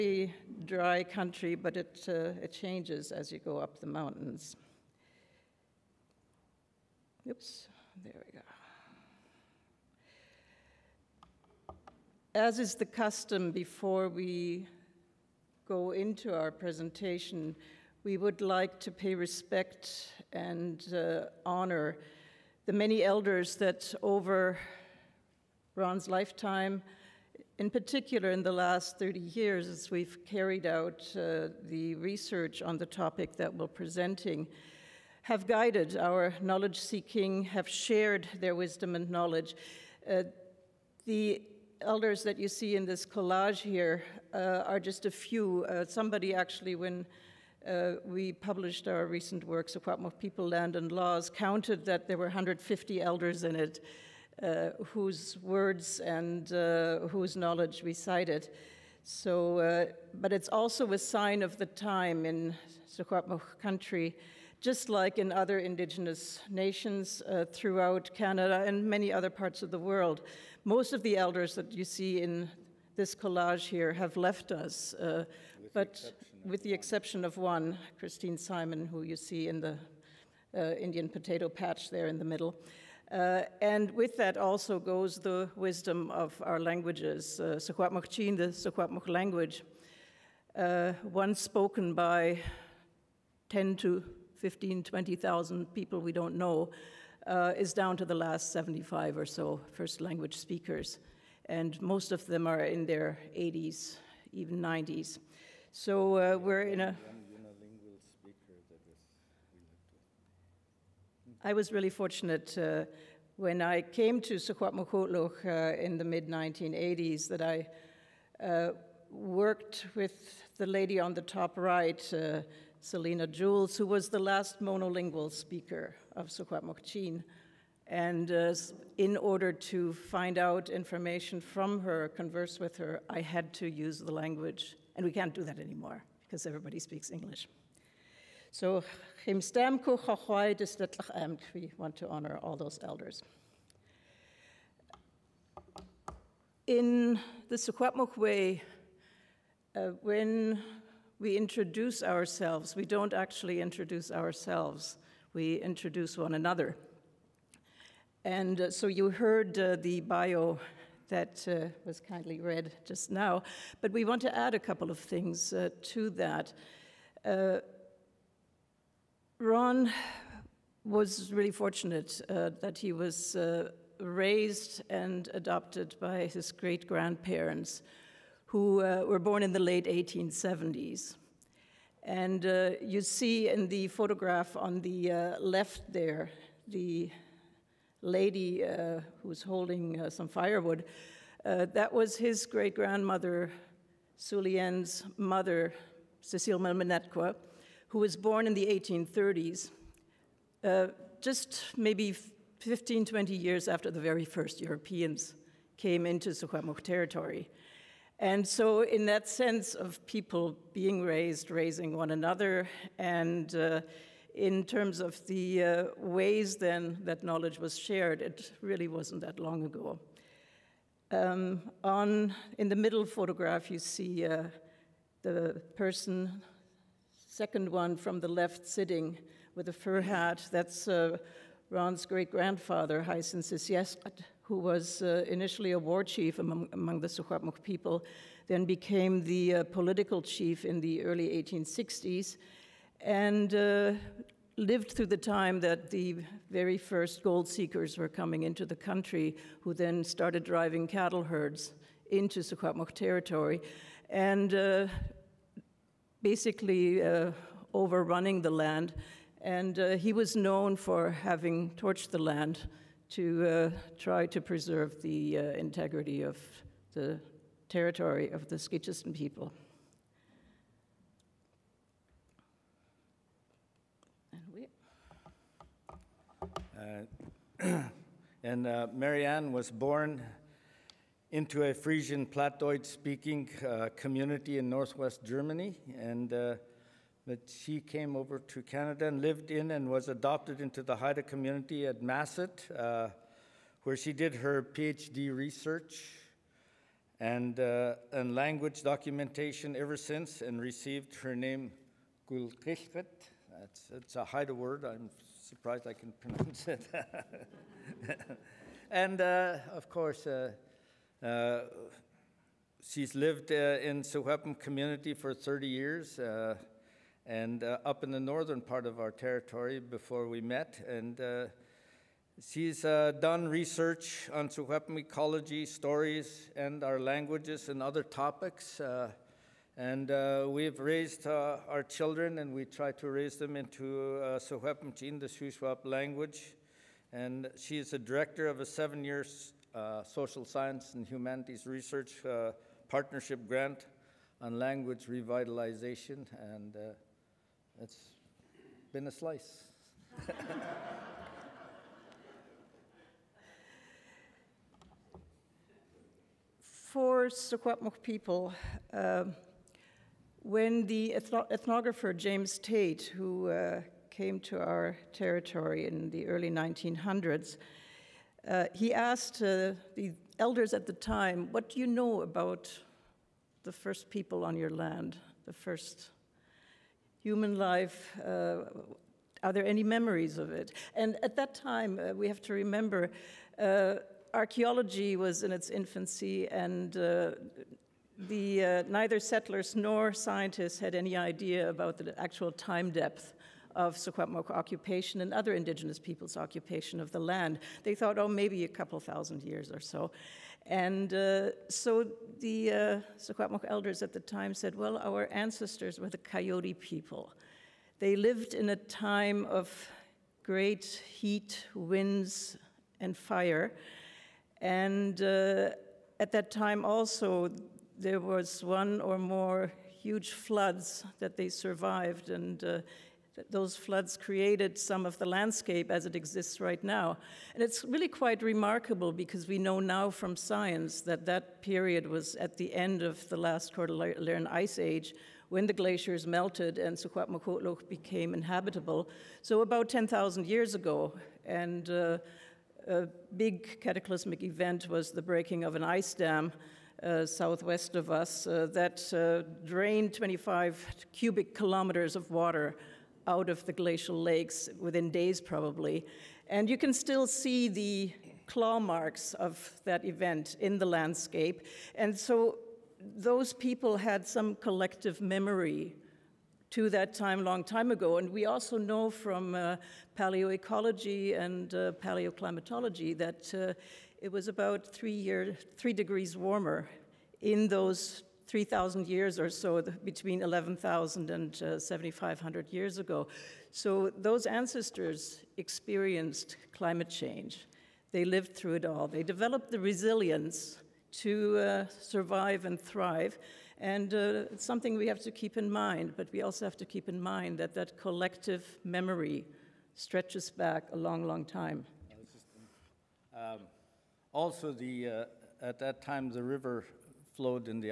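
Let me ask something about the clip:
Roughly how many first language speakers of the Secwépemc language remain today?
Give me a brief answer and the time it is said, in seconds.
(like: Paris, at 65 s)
75, at 98 s.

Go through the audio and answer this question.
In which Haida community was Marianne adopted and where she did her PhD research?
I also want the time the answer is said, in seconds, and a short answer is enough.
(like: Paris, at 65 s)
Massett, at 292 s.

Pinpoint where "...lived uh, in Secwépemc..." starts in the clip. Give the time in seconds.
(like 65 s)
313 s.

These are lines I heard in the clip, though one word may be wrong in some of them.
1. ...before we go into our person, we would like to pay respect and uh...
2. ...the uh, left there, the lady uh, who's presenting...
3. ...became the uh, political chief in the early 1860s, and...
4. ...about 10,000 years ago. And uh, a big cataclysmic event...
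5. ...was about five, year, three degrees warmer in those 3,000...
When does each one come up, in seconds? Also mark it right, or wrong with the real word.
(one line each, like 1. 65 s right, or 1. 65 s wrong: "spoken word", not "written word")
1. 13 s wrong: "presentation", not "person"
2. 184 s wrong: "holding", not "presenting"
3. 238 s right
4. 439 s right
5. 474 s wrong: "three", not "five".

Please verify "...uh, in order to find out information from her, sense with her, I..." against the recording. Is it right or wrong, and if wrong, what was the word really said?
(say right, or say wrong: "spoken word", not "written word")
wrong: "converse", not "sense".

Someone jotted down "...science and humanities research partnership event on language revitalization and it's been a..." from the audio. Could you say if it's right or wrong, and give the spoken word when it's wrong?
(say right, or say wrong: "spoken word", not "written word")
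wrong: "grant", not "event".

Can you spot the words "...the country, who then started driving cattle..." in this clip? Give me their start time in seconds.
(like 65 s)
248 s.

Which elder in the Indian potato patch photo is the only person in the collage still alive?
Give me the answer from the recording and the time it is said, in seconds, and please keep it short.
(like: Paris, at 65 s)
Christine Simon, at 77 s.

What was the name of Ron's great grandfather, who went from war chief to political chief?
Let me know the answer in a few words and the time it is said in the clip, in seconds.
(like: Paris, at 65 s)
Hyson Sisyeskat, at 233 s.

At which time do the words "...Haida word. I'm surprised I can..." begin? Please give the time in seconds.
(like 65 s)
304 s.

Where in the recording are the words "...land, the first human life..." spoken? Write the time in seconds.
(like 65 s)
374 s.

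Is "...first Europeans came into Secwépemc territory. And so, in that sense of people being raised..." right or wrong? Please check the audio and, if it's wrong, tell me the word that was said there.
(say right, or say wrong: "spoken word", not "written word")
right.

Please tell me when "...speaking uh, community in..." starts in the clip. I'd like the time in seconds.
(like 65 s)
282 s.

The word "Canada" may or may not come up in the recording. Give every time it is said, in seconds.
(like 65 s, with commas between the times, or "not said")
68 s, 288 s.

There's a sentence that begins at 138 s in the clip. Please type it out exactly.
So, we want to honor all those elders.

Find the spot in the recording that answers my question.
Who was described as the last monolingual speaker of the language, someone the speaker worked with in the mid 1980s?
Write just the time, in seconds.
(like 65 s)
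122 s.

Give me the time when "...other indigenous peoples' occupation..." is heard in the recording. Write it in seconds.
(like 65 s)
395 s.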